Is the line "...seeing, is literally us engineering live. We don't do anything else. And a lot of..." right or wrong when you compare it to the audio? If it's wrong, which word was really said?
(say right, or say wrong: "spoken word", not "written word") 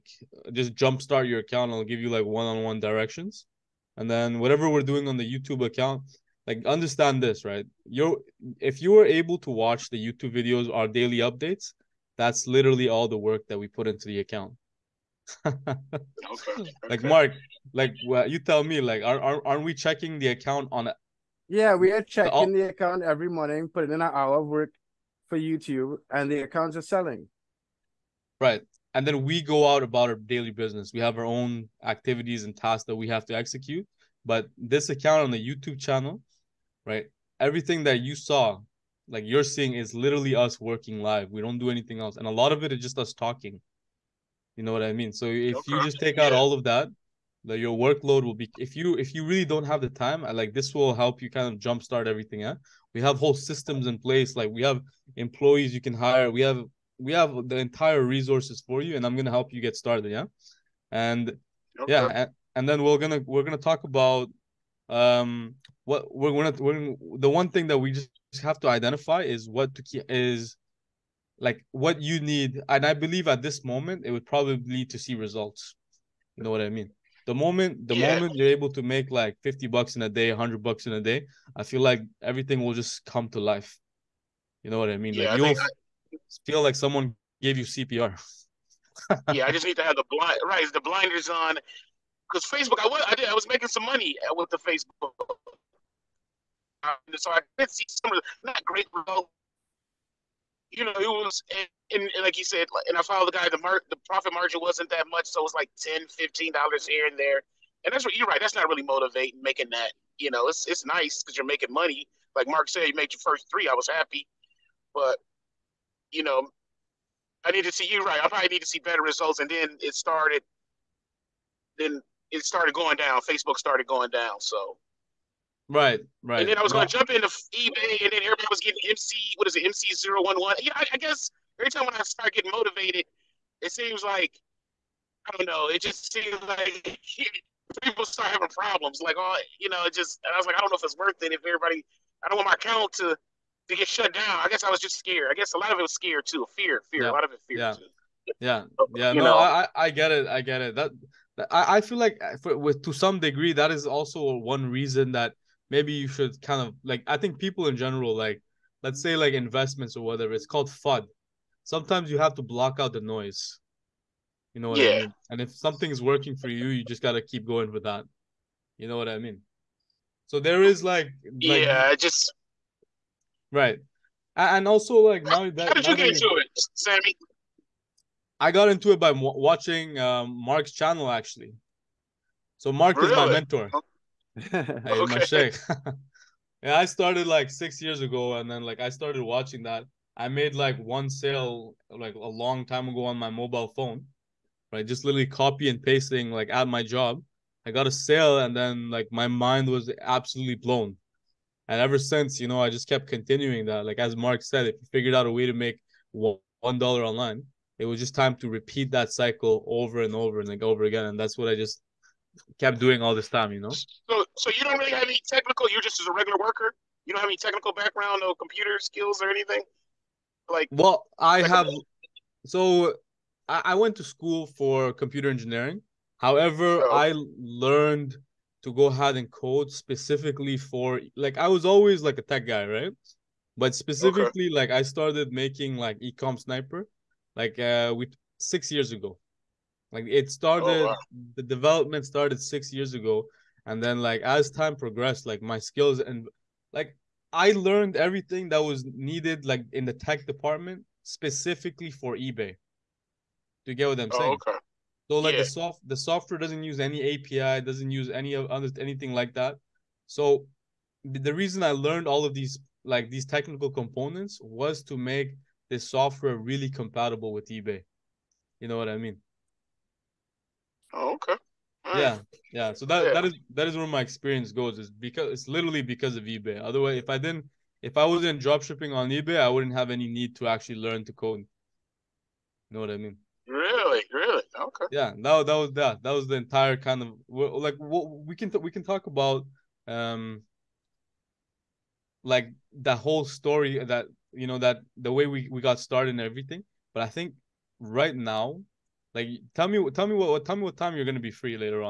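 wrong: "working", not "engineering".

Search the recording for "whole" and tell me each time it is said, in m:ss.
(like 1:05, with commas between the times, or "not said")
0:53, 4:52.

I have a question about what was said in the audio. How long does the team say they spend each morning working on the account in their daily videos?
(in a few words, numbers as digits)
an hour.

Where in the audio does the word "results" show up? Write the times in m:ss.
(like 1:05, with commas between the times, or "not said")
1:15, 1:38, 1:59.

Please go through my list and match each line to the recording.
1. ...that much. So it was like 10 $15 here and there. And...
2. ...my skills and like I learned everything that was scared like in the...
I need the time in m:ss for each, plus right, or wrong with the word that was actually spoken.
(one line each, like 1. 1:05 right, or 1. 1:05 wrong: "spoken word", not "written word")
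1. 1:44 right
2. 4:05 wrong: "needed", not "scared".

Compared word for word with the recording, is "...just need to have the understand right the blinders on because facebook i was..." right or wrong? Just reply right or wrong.
wrong.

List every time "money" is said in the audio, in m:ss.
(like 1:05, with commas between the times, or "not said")
1:33, 1:51.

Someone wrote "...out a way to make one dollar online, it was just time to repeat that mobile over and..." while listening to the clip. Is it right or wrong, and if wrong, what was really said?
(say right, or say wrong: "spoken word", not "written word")
wrong: "cycle", not "mobile".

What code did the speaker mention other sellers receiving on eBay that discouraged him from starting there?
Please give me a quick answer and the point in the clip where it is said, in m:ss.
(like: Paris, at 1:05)
MC 011, at 2:09.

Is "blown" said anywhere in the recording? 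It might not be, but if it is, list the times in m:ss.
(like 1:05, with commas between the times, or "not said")
3:20.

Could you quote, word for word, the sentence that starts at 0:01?
I'll give you like one-on-one directions, and then whatever we're doing on the YouTube account, like understand this right.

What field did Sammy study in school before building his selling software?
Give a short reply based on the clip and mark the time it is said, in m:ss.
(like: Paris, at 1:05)
computer engineering, at 3:44.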